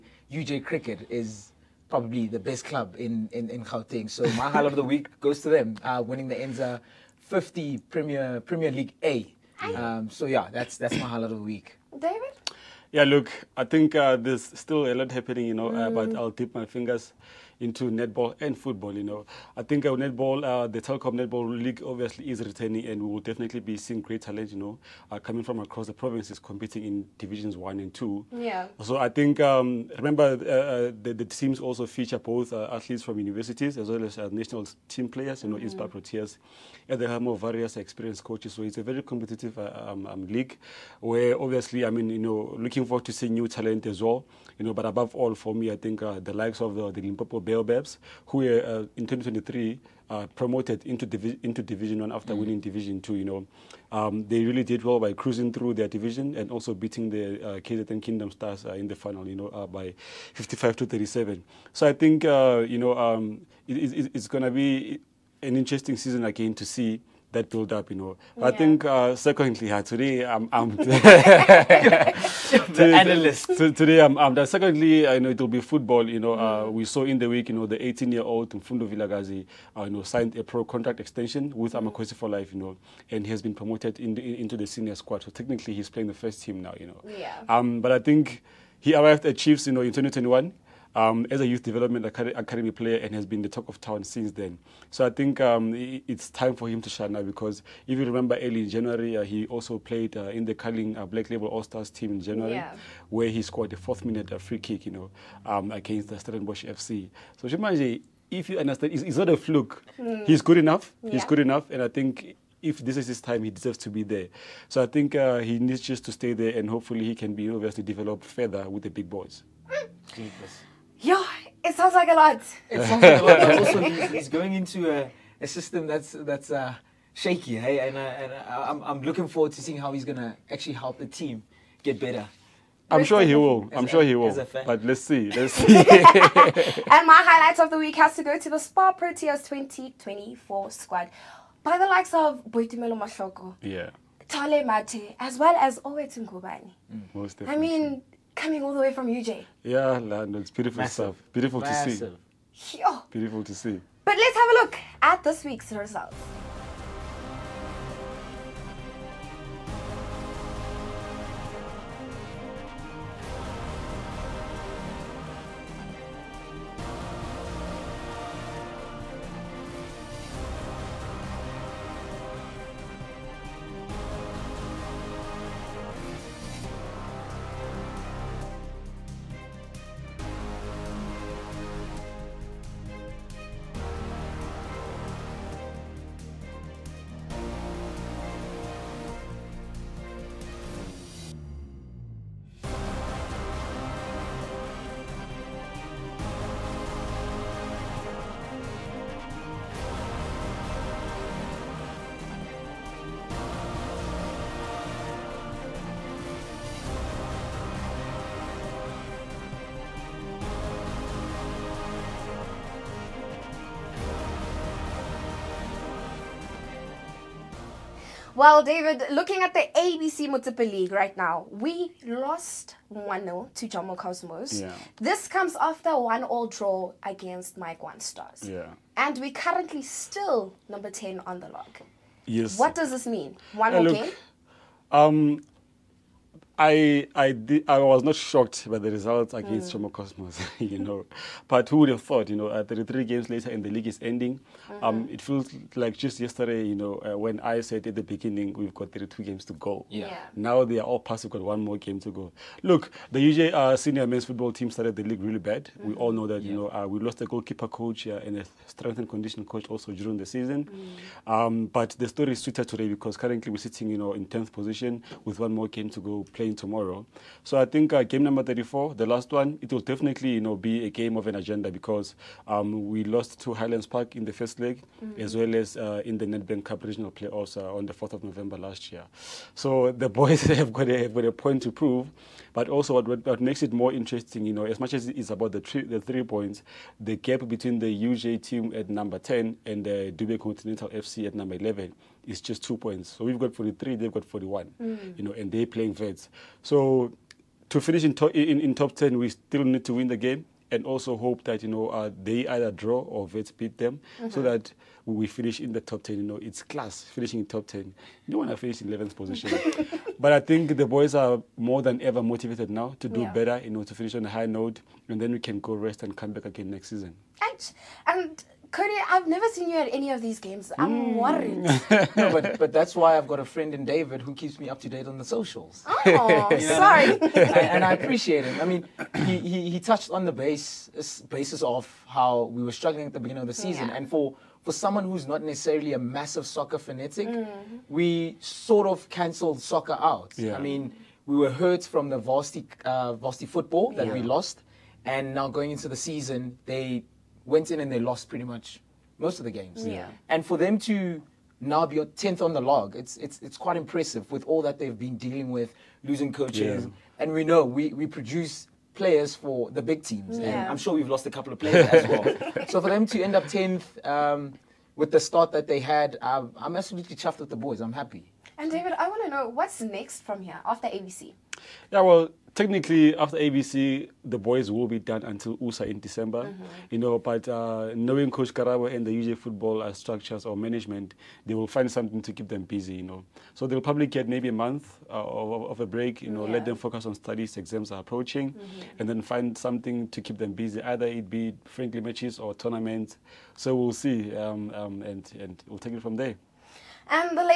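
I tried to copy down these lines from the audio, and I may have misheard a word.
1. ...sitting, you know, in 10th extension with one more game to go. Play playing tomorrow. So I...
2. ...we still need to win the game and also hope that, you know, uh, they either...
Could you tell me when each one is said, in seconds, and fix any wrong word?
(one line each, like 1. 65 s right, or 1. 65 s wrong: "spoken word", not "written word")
1. 263 s wrong: "position", not "extension"
2. 299 s right.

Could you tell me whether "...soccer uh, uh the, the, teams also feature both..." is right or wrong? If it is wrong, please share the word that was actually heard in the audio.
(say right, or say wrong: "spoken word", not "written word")
wrong: "remember", not "soccer".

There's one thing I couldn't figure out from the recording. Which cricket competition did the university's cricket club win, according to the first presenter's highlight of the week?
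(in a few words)
Enza 50 Premier League A.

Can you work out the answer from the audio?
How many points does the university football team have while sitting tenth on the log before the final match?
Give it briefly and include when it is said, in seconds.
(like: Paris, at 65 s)
43, at 293 s.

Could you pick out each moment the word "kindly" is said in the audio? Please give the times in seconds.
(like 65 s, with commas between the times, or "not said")
not said.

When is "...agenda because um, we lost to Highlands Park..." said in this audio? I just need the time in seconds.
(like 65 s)
271 s.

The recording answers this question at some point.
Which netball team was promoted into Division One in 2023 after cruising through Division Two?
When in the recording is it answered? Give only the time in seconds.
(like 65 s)
46 s.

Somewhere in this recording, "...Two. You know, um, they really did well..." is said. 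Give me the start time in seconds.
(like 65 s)
53 s.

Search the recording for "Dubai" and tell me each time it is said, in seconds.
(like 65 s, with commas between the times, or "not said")
290 s.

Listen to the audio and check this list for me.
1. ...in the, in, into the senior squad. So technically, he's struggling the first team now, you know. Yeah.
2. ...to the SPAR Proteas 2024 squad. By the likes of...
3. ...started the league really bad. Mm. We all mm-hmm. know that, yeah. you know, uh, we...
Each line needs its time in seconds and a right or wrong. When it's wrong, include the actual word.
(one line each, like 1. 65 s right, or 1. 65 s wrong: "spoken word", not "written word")
1. 83 s wrong: "playing", not "struggling"
2. 138 s right
3. 254 s right.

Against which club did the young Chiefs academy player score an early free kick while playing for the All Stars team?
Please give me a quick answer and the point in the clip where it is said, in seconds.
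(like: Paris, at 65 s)
Stellenbosch FC, at 106 s.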